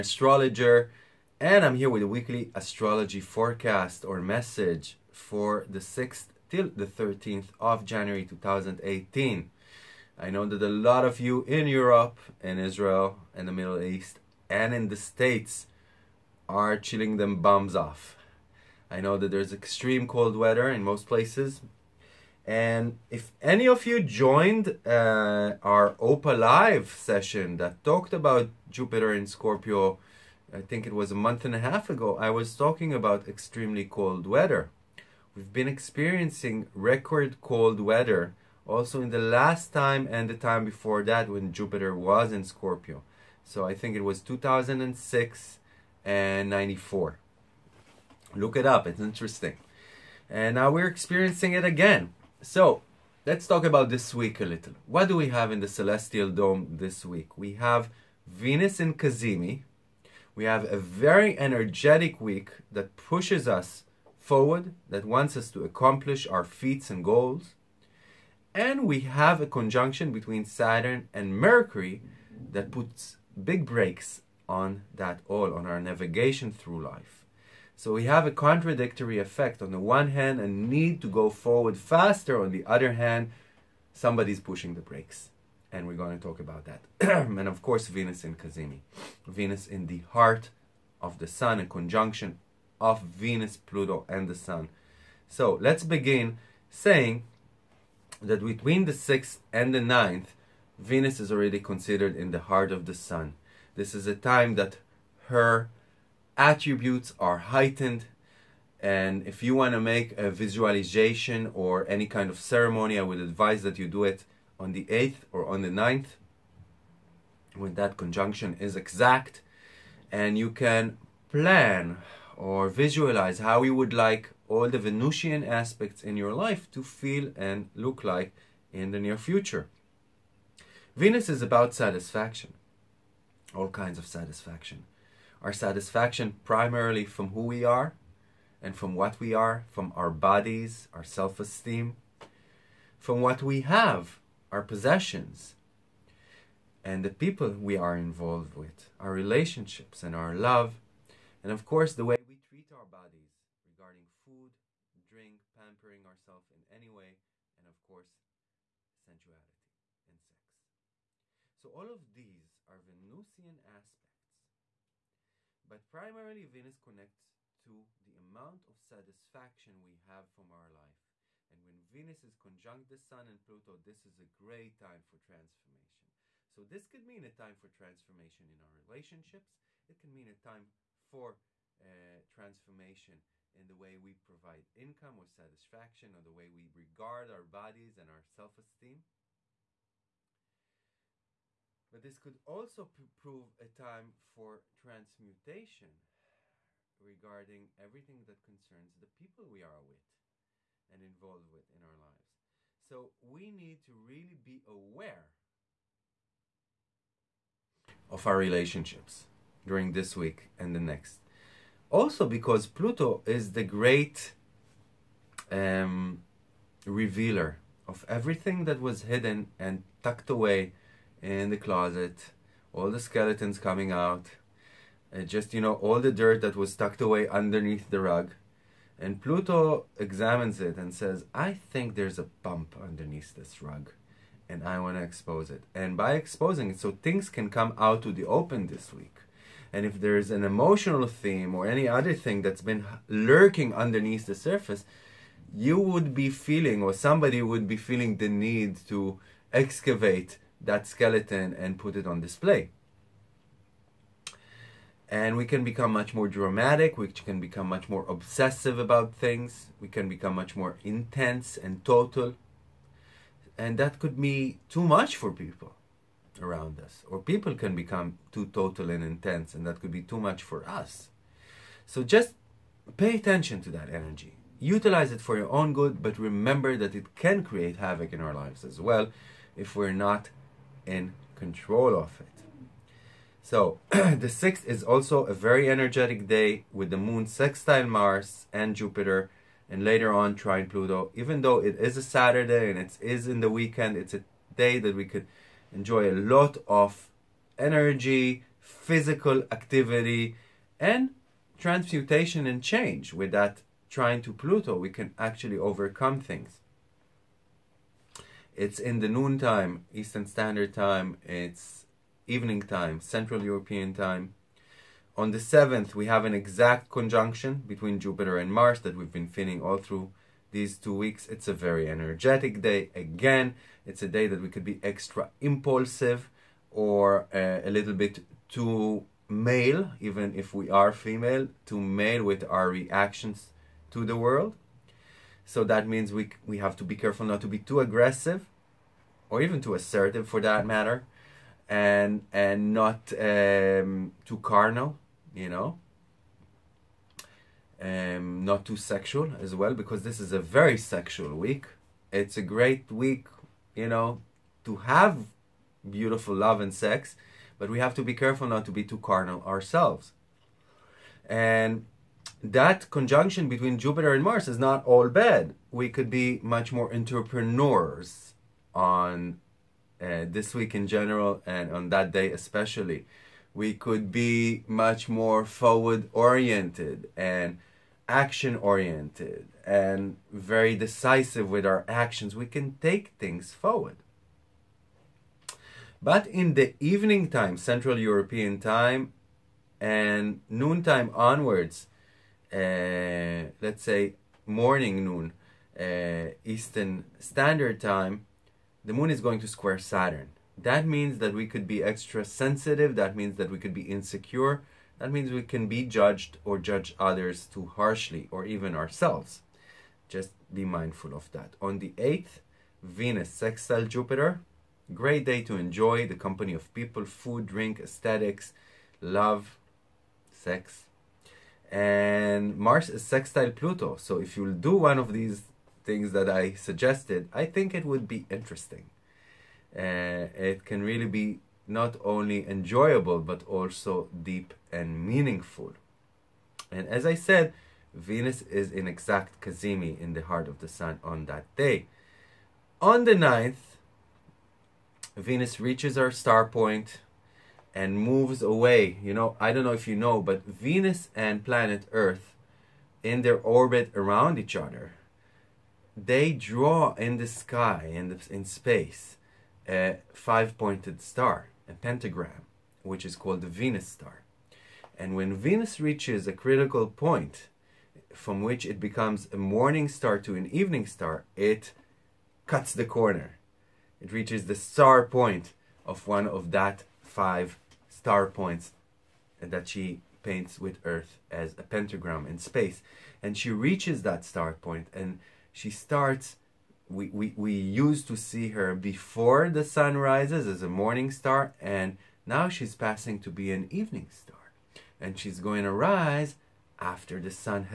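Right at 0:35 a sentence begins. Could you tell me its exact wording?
We've been experiencing record cold weather also in the last time and the time before that when Jupiter was in Scorpio.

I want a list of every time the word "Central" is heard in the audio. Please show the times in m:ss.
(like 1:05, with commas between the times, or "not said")
5:12, 6:27.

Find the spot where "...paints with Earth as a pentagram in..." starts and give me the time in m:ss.
8:00.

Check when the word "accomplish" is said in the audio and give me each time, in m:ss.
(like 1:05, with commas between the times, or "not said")
1:05.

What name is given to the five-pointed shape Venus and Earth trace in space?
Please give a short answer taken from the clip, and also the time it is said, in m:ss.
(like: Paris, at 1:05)
Venus star, at 7:43.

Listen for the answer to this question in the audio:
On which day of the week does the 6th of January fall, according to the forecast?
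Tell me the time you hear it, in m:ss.
4:52.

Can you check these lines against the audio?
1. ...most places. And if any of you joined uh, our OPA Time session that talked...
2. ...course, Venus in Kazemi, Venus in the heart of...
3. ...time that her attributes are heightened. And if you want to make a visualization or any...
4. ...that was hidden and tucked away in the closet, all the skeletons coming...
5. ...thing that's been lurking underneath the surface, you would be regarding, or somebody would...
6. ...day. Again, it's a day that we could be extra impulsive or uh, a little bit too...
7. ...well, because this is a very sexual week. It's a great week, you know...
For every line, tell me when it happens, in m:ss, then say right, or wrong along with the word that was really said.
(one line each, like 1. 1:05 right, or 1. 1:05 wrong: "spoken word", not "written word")
1. 0:20 wrong: "Live", not "Time"
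2. 1:27 right
3. 1:44 right
4. 3:38 right
5. 4:02 wrong: "feeling", not "regarding"
6. 5:22 right
7. 5:49 right.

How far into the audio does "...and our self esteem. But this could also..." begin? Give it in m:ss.
3:07.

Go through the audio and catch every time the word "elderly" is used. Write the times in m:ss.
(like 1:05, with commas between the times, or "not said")
not said.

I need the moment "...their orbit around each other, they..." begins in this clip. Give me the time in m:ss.
7:33.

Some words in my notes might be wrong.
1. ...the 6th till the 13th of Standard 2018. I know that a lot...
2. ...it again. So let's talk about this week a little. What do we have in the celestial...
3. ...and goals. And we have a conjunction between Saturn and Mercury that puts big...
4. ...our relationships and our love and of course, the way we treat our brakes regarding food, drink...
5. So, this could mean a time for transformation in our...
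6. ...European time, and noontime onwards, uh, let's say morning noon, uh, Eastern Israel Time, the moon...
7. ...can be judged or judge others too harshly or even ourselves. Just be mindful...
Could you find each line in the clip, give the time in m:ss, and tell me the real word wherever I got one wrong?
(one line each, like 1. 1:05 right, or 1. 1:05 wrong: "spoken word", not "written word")
1. 0:05 wrong: "January", not "Standard"
2. 0:51 right
3. 1:06 right
4. 2:28 wrong: "bodies", not "brakes"
5. 2:56 right
6. 6:27 wrong: "Standard", not "Israel"
7. 6:45 right.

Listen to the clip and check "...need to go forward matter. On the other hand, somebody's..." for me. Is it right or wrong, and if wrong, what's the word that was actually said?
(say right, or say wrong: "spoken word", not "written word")
wrong: "faster", not "matter".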